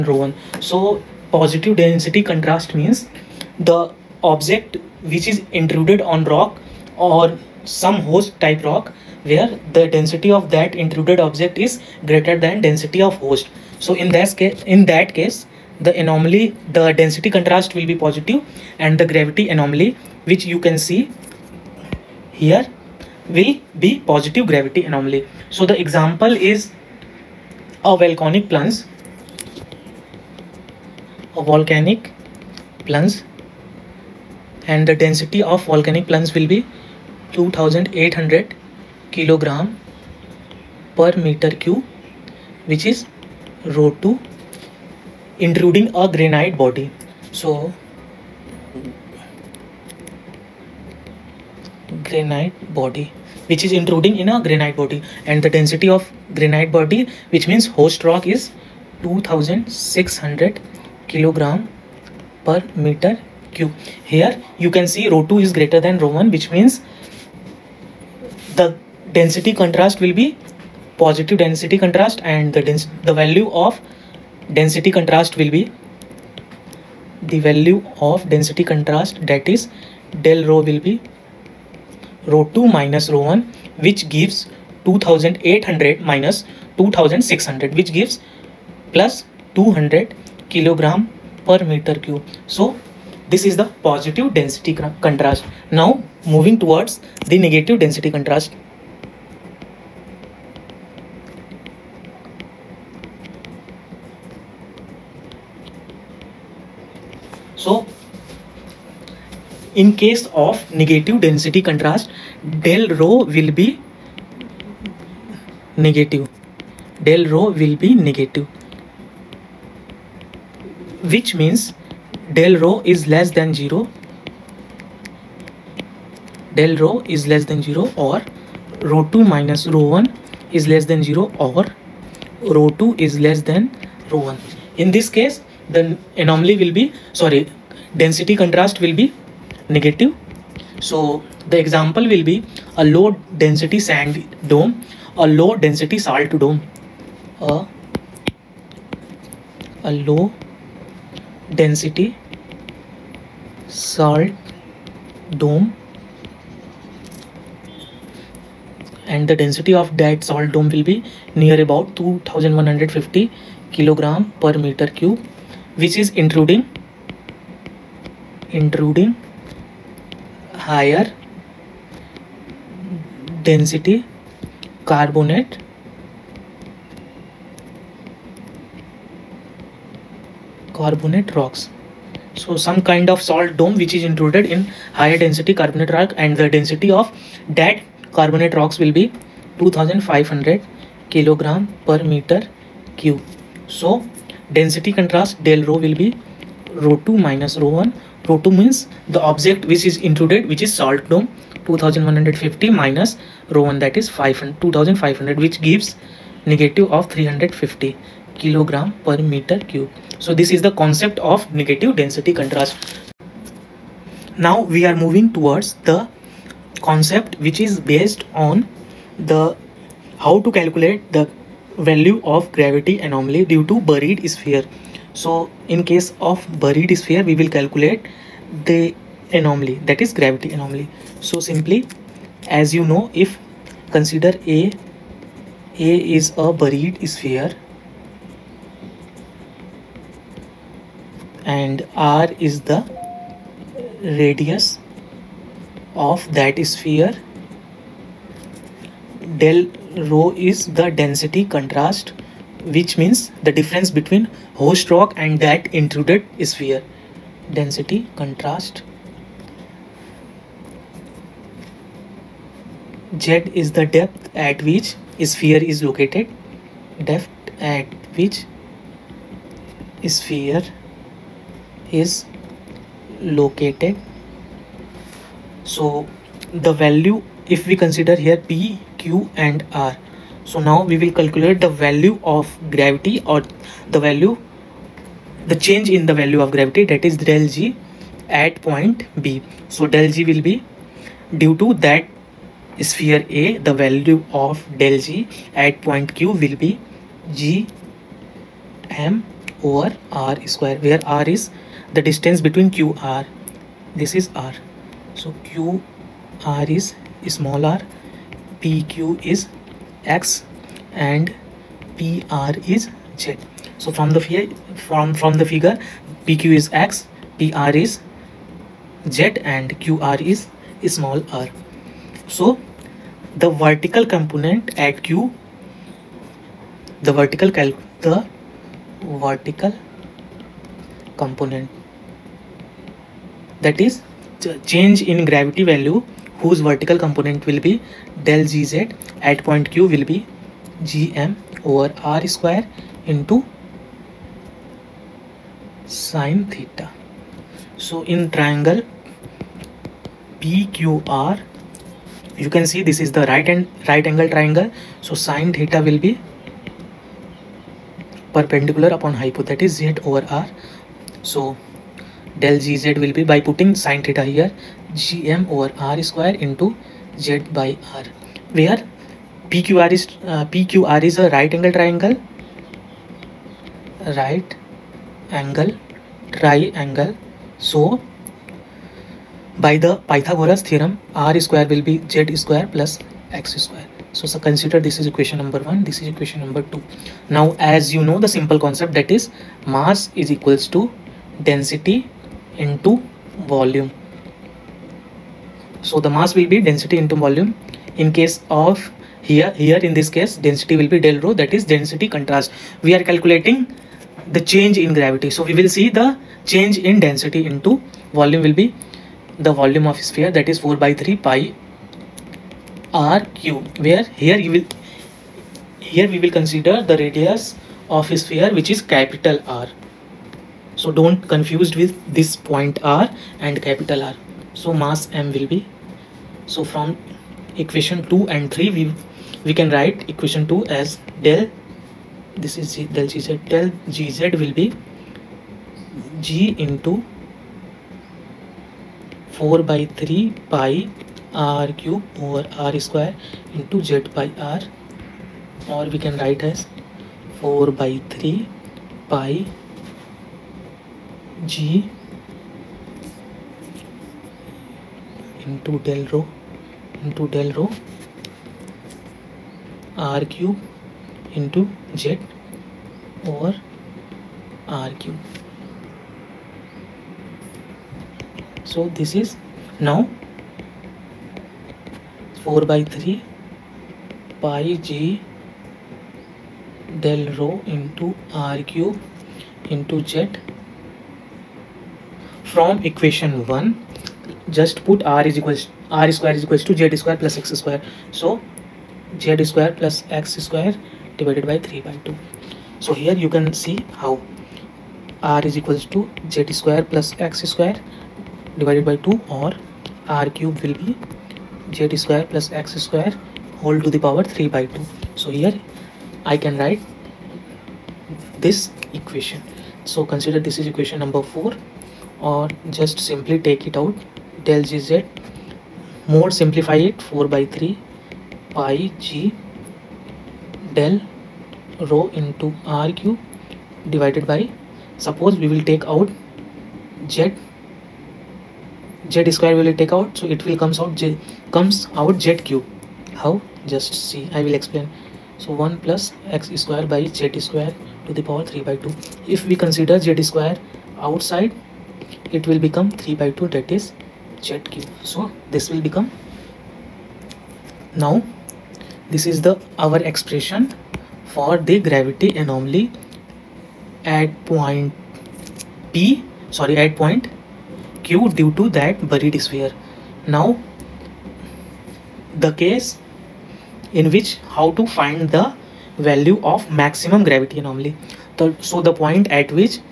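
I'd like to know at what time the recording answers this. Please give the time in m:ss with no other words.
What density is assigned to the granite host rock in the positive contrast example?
0:59.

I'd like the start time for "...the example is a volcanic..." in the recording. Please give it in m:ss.
0:25.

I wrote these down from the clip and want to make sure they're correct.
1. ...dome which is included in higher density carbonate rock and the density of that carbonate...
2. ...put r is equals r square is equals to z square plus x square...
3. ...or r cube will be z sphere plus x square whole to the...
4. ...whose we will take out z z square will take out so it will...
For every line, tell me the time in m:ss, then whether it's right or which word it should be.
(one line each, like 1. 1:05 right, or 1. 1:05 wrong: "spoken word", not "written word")
1. 3:03 right
2. 8:04 right
3. 8:19 wrong: "square", not "sphere"
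4. 8:45 wrong: "suppose", not "whose".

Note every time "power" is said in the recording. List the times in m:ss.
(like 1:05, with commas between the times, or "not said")
8:24, 8:58.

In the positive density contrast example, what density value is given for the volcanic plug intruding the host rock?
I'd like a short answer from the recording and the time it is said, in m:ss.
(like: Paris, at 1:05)
2800 kg/m³, at 0:37.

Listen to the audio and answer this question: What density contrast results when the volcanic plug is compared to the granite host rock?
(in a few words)
+200 kg/m³.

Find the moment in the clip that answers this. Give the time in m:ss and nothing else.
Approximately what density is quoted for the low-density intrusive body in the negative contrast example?
2:41.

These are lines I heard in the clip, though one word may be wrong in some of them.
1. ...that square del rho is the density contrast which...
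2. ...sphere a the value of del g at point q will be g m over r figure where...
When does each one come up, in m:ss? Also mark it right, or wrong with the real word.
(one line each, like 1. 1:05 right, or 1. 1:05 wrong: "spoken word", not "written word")
1. 4:06 wrong: "sphere", not "square"
2. 4:52 wrong: "square", not "figure".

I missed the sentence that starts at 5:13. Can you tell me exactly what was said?
So from the figure from from the figure PQ is x, PR is z and QR is small r.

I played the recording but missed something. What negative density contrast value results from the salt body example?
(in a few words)
-350 kg/m³.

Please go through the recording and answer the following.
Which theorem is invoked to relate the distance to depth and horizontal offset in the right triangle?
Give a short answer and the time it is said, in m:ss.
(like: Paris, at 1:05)
Pythagoras theorem, at 6:20.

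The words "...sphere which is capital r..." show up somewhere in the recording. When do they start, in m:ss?
6:58.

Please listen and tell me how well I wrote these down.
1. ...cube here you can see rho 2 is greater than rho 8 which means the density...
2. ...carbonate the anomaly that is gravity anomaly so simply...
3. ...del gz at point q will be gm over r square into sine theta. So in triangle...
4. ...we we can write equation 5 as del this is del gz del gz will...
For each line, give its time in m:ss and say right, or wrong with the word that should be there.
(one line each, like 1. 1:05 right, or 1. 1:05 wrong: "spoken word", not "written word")
1. 1:03 wrong: "1", not "8"
2. 3:47 wrong: "calculate", not "carbonate"
3. 5:38 right
4. 7:08 wrong: "2", not "5".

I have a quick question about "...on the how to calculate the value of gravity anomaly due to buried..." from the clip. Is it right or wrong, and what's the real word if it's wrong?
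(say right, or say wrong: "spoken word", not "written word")
right.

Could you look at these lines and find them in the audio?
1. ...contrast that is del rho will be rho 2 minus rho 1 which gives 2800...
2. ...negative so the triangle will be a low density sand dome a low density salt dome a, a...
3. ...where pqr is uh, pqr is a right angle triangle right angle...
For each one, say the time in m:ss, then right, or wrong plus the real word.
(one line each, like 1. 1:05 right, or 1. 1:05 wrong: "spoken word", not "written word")
1. 1:18 right
2. 2:19 wrong: "example", not "triangle"
3. 6:08 right.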